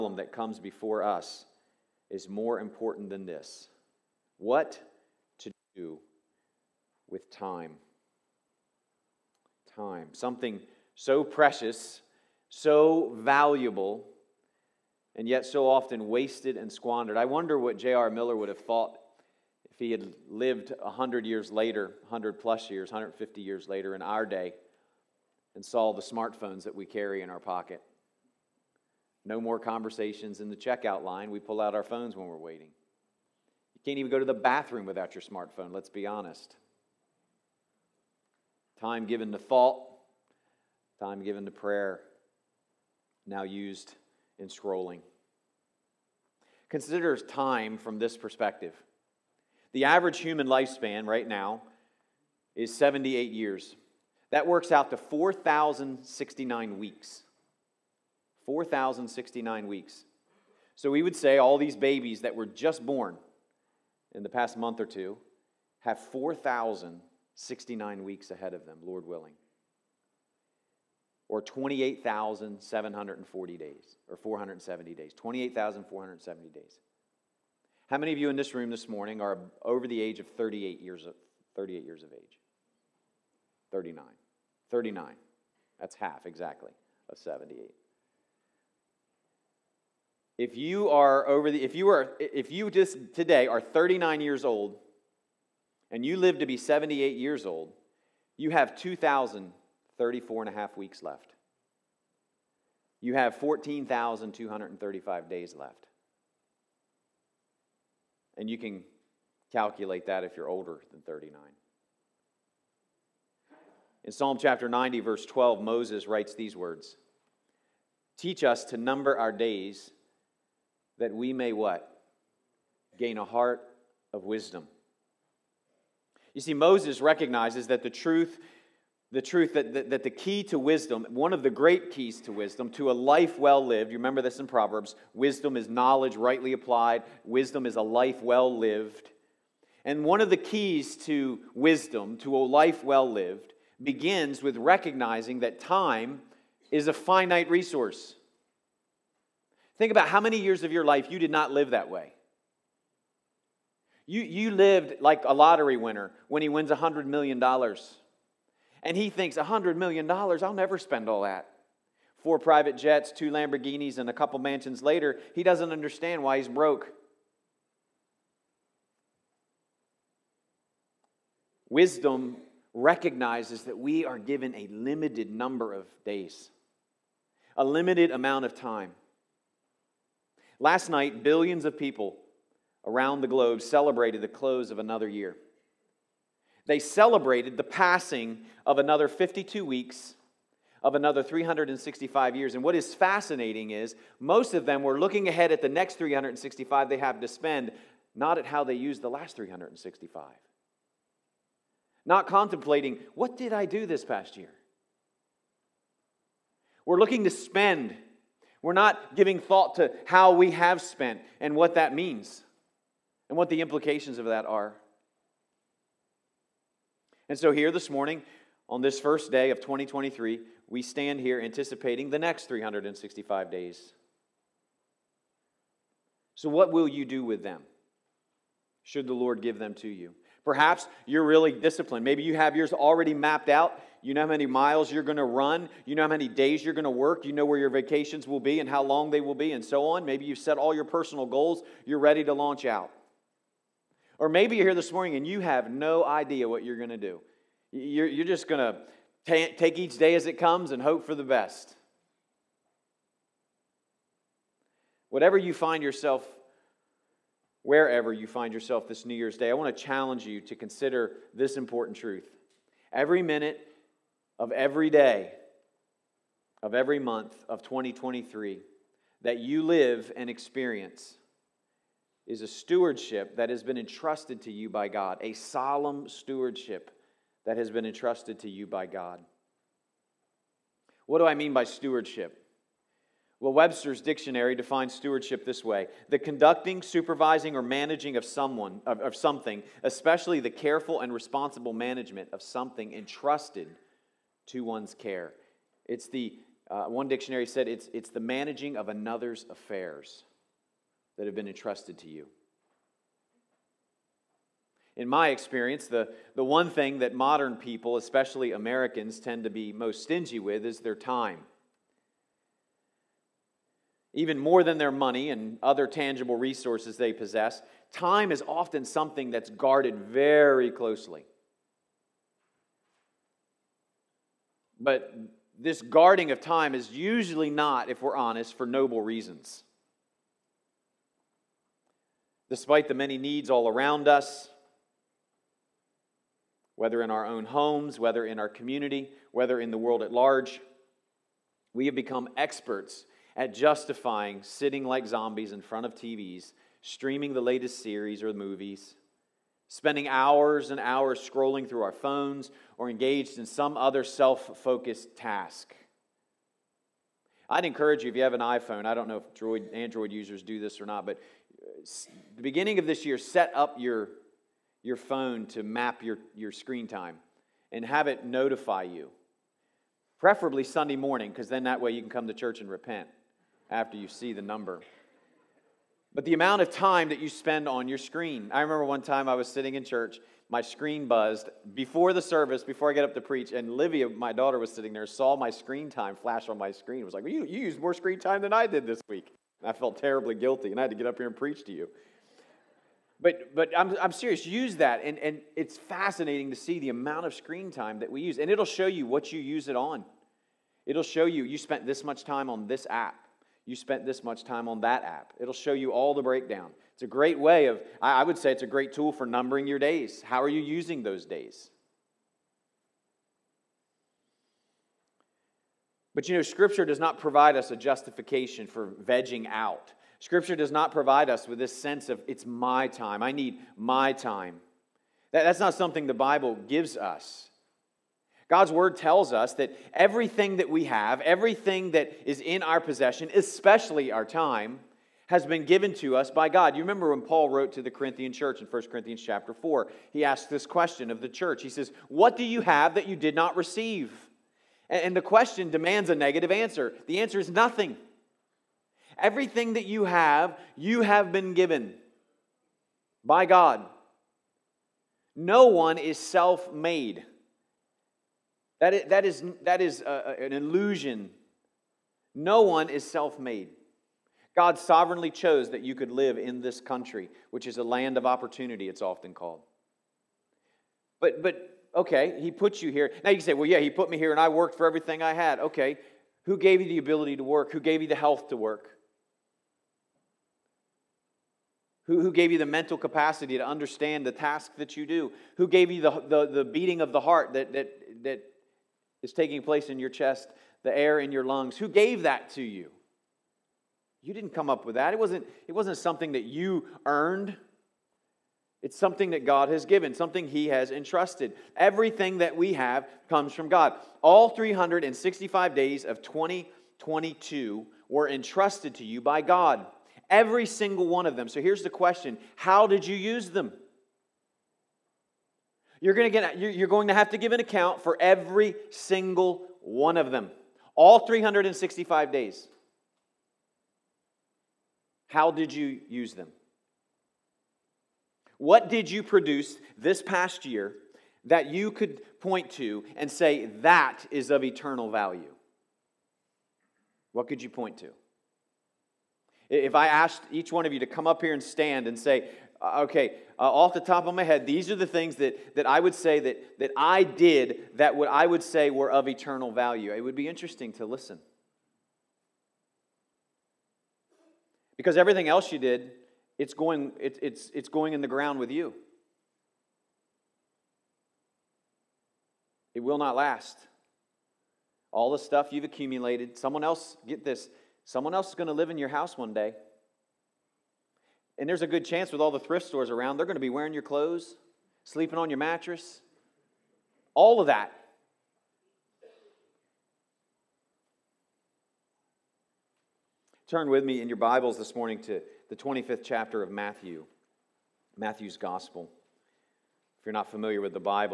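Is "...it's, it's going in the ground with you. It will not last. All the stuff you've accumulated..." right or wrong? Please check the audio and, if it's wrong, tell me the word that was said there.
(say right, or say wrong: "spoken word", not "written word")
right.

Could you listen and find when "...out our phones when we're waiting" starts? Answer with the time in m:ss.
0:31.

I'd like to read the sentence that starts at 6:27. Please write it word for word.
It was like, well, you, you used more screen time than I did this week.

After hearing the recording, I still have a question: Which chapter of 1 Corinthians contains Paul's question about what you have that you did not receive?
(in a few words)
Chapter 4.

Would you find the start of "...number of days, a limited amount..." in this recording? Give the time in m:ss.
2:55.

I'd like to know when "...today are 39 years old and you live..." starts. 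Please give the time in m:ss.
1:33.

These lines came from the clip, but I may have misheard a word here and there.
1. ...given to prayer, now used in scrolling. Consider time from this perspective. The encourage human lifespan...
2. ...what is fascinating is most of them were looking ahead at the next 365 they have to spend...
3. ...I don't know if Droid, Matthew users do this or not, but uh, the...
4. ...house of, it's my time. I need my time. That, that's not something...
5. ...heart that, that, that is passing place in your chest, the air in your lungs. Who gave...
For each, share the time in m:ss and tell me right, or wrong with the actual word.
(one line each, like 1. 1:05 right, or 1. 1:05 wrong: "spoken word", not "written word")
1. 0:41 wrong: "average", not "encourage"
2. 3:12 right
3. 5:58 wrong: "Android", not "Matthew"
4. 7:01 wrong: "sense", not "house"
5. 8:07 wrong: "taking", not "passing".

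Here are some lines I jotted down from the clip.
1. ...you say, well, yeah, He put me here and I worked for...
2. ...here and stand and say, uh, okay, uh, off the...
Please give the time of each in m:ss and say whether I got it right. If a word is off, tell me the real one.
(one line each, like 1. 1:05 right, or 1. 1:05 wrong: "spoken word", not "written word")
1. 7:53 right
2. 9:01 right.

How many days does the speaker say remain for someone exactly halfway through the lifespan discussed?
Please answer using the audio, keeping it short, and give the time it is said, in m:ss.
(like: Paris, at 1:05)
14,235, at 1:43.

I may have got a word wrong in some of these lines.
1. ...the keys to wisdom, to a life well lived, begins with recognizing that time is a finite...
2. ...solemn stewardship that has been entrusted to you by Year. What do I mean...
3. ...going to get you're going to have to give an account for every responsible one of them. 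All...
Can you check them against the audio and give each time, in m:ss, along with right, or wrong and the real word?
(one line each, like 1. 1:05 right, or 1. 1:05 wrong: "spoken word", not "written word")
1. 2:20 right
2. 4:35 wrong: "God", not "Year"
3. 8:36 wrong: "single", not "responsible".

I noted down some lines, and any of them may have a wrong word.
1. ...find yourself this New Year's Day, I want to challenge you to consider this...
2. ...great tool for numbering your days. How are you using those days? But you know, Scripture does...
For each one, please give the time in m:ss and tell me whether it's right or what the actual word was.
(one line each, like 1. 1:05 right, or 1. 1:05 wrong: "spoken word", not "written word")
1. 4:18 right
2. 6:48 right.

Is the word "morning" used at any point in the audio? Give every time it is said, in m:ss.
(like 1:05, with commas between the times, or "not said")
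1:18, 3:37, 4:04, 6:10, 9:44.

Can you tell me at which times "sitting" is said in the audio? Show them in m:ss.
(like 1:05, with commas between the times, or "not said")
5:44, 6:19, 6:24.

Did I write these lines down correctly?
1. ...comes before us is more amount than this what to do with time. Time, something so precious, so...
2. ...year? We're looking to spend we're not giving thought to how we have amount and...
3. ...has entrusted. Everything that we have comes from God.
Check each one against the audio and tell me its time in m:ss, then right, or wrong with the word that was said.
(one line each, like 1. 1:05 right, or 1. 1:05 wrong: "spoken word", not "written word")
1. 0:00 wrong: "important", not "amount"
2. 3:24 wrong: "spent", not "amount"
3. 8:20 right.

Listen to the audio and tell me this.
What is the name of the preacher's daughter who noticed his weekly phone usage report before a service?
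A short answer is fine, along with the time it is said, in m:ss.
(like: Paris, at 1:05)
Livia, at 6:23.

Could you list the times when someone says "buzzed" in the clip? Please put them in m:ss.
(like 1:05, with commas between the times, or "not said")
6:21.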